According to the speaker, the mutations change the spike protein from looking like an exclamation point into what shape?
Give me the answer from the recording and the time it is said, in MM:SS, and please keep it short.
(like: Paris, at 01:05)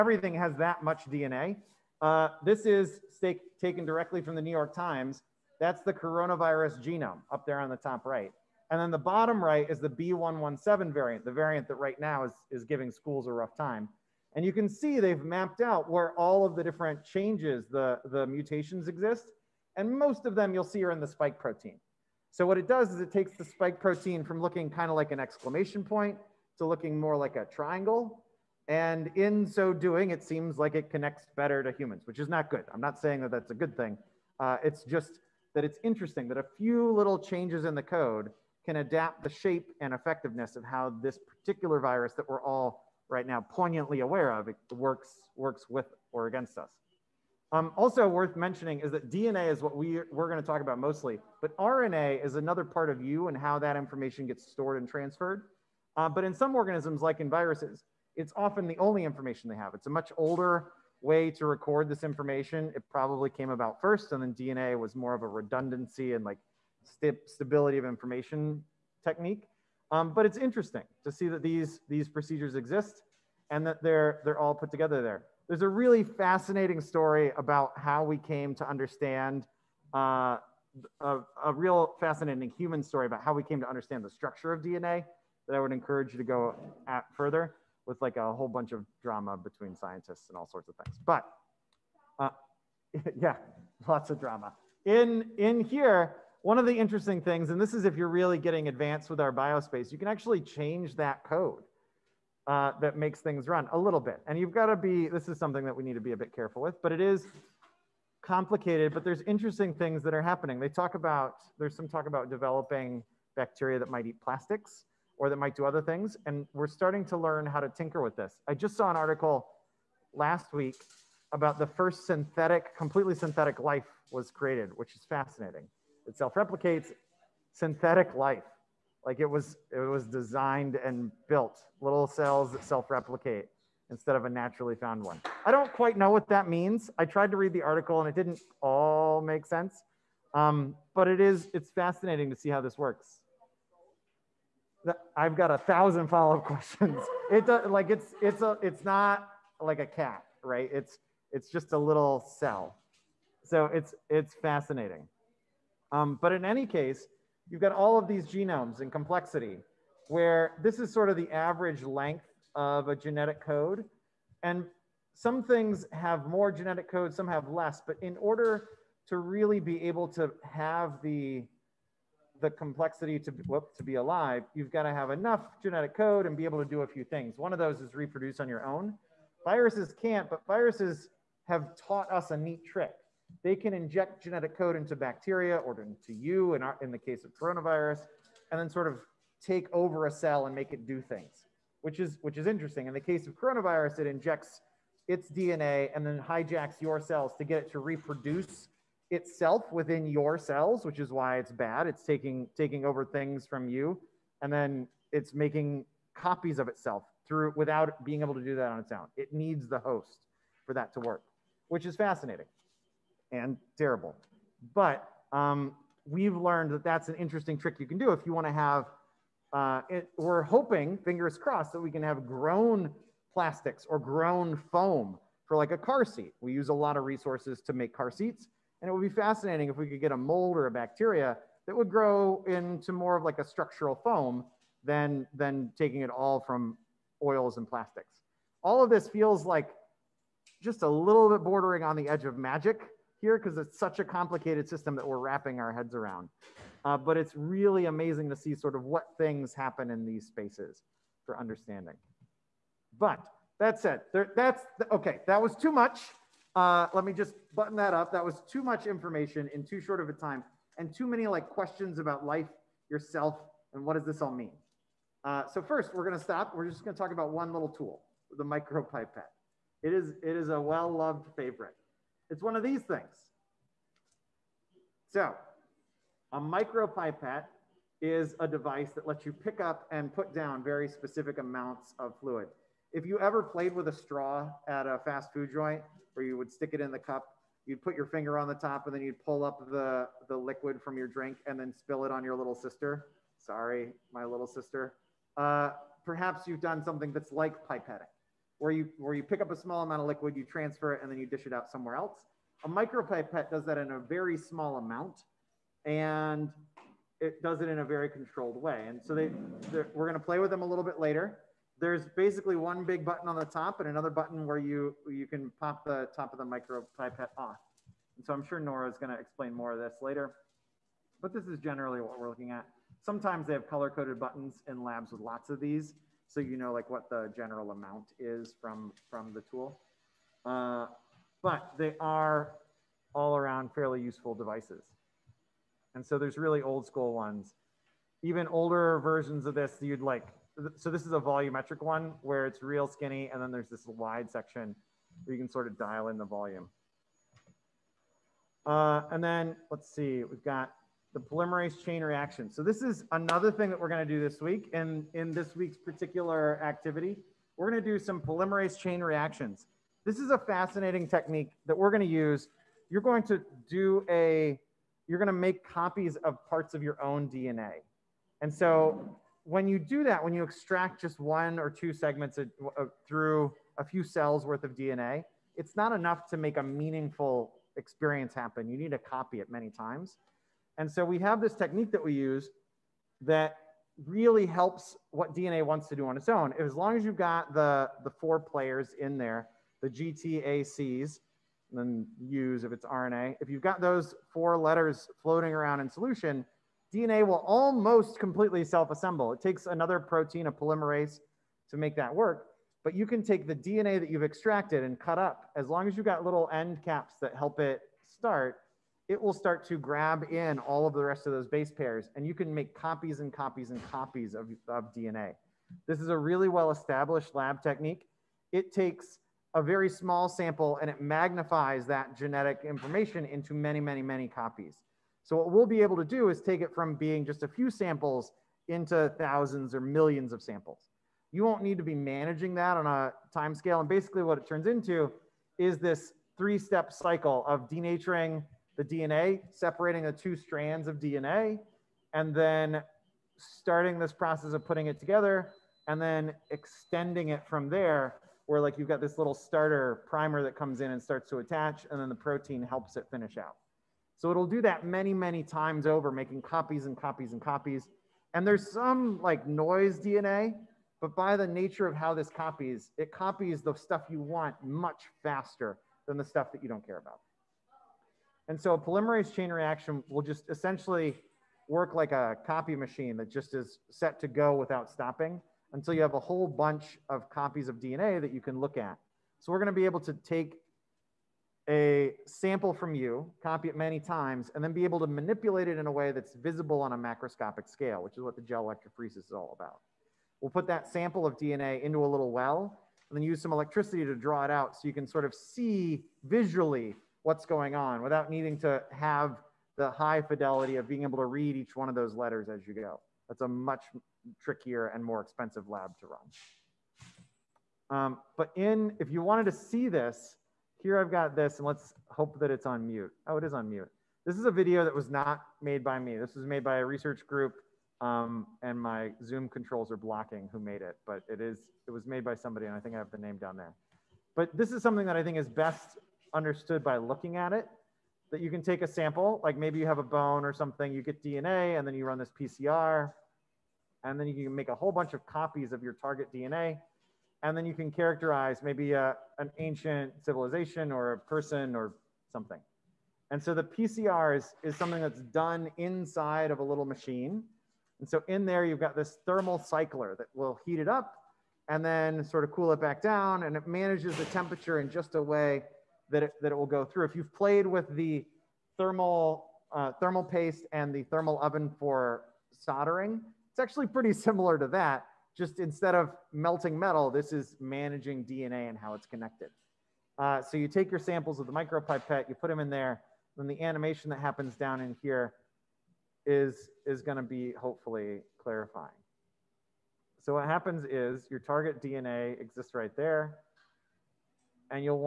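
triangle, at 00:27.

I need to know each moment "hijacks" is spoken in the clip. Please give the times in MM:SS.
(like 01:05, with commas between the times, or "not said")
03:16.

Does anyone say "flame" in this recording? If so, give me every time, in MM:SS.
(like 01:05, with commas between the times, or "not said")
not said.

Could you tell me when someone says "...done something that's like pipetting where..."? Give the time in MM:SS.
04:56.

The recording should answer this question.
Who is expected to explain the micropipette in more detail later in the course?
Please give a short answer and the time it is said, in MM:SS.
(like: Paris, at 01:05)
Nora, at 05:18.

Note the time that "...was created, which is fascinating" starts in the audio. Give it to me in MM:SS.
02:04.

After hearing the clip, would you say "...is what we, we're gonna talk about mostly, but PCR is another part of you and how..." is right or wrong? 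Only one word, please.
wrong.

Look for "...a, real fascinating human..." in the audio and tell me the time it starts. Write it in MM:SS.
01:21.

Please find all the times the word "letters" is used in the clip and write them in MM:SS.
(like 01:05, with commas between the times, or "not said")
06:34, 08:22.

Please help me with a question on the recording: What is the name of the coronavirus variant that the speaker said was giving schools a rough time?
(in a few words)
B117.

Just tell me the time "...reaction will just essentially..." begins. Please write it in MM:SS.
07:49.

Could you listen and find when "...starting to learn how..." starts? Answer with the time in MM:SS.
01:56.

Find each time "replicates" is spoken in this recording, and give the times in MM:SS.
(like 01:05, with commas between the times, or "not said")
02:06, 02:12.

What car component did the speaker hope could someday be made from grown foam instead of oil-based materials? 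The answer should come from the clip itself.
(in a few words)
car seat.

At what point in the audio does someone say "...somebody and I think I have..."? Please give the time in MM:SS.
08:42.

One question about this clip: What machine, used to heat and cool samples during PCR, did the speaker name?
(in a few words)
thermal cycler.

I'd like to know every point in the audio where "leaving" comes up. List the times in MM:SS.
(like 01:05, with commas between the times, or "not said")
not said.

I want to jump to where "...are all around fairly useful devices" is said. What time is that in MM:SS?
05:31.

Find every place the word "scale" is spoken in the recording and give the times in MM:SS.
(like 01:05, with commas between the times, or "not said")
07:13, 08:07.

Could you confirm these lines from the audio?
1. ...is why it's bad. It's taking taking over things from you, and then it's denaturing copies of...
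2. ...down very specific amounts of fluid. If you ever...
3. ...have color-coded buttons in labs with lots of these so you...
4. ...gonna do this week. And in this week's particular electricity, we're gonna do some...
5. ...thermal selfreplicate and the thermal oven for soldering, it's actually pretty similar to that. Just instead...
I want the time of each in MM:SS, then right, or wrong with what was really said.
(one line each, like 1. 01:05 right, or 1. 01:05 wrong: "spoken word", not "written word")
1. 03:20 wrong: "making", not "denaturing"
2. 04:40 right
3. 05:23 right
4. 05:53 wrong: "activity", not "electricity"
5. 09:19 wrong: "paste", not "selfreplicate".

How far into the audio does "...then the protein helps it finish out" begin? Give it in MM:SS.
07:32.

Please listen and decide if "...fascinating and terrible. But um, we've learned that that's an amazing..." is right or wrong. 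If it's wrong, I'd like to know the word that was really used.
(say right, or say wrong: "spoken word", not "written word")
wrong: "interesting", not "amazing".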